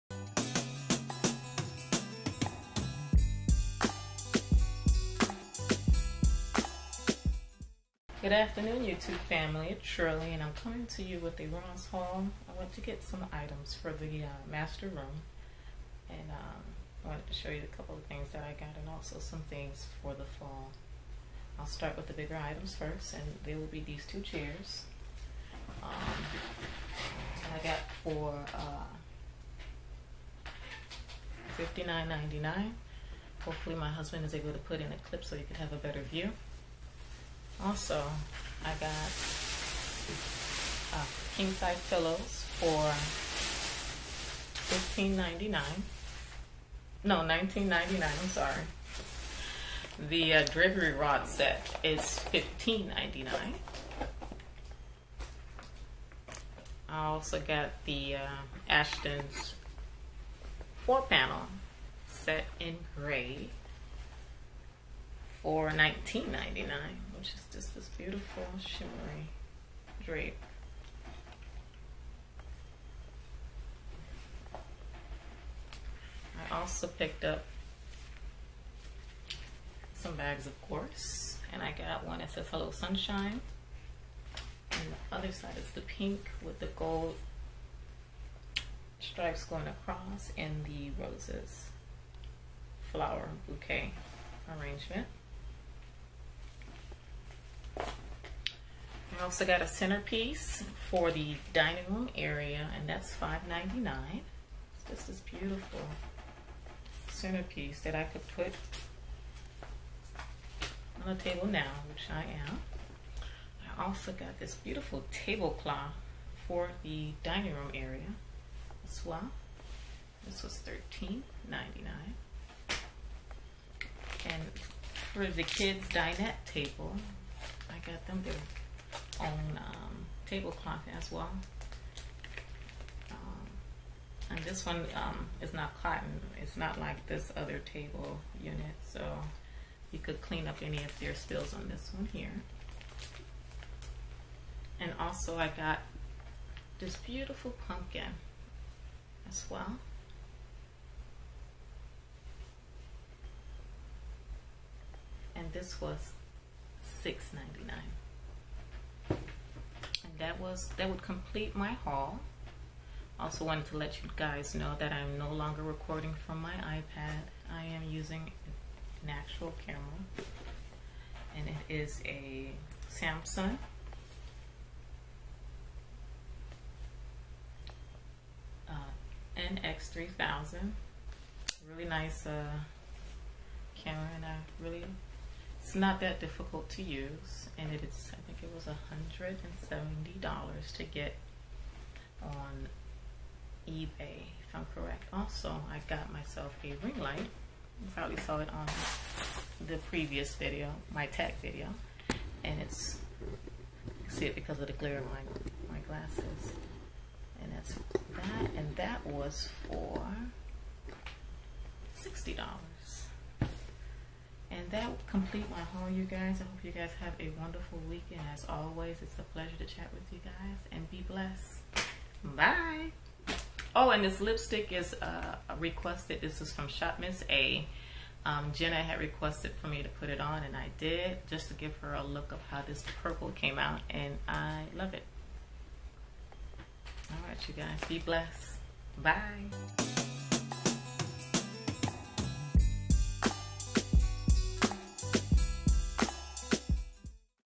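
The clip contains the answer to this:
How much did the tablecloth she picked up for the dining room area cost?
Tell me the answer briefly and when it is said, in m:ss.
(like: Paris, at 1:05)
$13.99, at 2:00.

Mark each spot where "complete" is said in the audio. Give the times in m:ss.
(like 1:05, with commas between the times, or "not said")
2:41, 3:35.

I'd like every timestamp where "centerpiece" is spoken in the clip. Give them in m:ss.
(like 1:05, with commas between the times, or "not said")
1:39, 1:47.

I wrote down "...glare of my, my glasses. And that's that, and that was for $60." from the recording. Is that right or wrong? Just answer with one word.
right.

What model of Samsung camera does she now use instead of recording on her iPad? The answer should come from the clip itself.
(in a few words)
NX3000.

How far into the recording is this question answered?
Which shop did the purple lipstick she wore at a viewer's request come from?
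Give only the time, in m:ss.
3:46.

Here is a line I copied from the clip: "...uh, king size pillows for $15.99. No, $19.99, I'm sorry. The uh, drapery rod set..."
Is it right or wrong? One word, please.
right.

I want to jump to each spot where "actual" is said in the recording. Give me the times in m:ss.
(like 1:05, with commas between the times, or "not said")
2:49.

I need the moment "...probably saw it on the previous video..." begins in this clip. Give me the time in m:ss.
3:17.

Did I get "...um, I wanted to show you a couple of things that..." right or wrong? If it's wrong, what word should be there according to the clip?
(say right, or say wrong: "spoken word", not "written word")
right.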